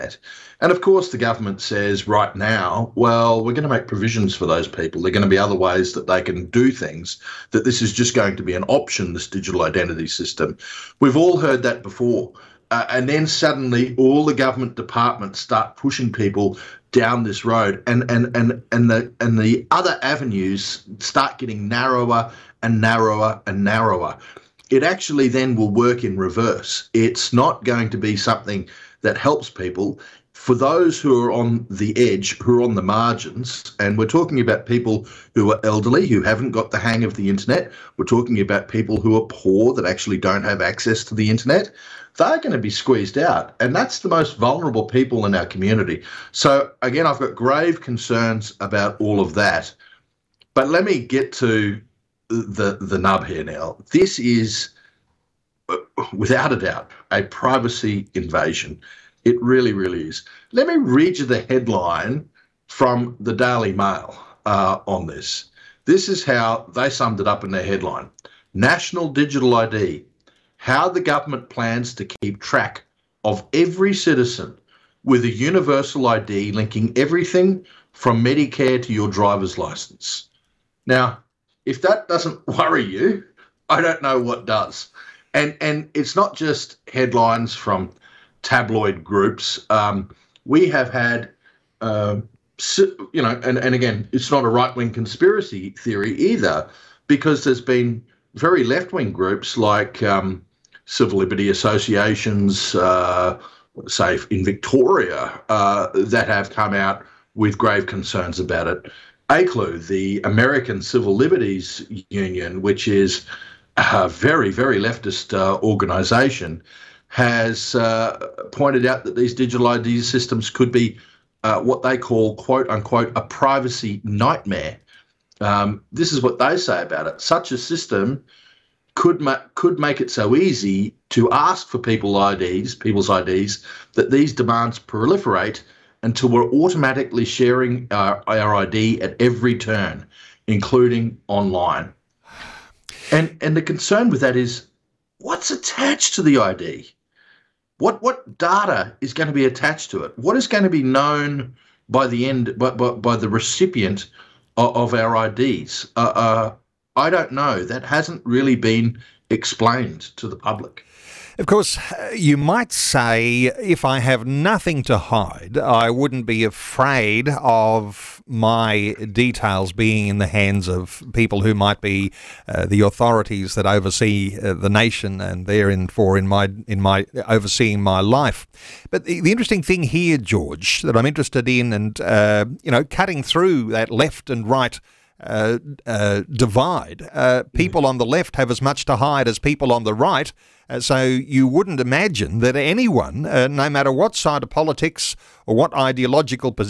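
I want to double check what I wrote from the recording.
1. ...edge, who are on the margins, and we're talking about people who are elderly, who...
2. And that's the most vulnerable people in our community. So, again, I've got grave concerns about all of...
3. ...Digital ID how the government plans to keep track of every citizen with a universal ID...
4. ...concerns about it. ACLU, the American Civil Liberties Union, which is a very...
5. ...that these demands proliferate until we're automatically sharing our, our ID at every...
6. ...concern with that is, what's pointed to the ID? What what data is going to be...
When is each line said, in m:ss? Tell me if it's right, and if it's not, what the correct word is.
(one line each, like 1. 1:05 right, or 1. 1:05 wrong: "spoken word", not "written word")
1. 0:31 right
2. 0:43 right
3. 1:09 right
4. 1:47 right
5. 2:13 right
6. 2:23 wrong: "attached", not "pointed".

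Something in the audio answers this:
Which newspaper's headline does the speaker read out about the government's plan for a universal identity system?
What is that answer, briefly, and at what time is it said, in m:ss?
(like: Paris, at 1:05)
Daily Mail, at 1:03.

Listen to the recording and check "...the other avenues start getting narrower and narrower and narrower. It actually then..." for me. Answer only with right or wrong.
right.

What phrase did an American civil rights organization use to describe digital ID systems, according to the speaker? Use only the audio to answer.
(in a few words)
privacy nightmare.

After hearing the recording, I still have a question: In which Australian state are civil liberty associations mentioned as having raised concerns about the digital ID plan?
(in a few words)
Victoria.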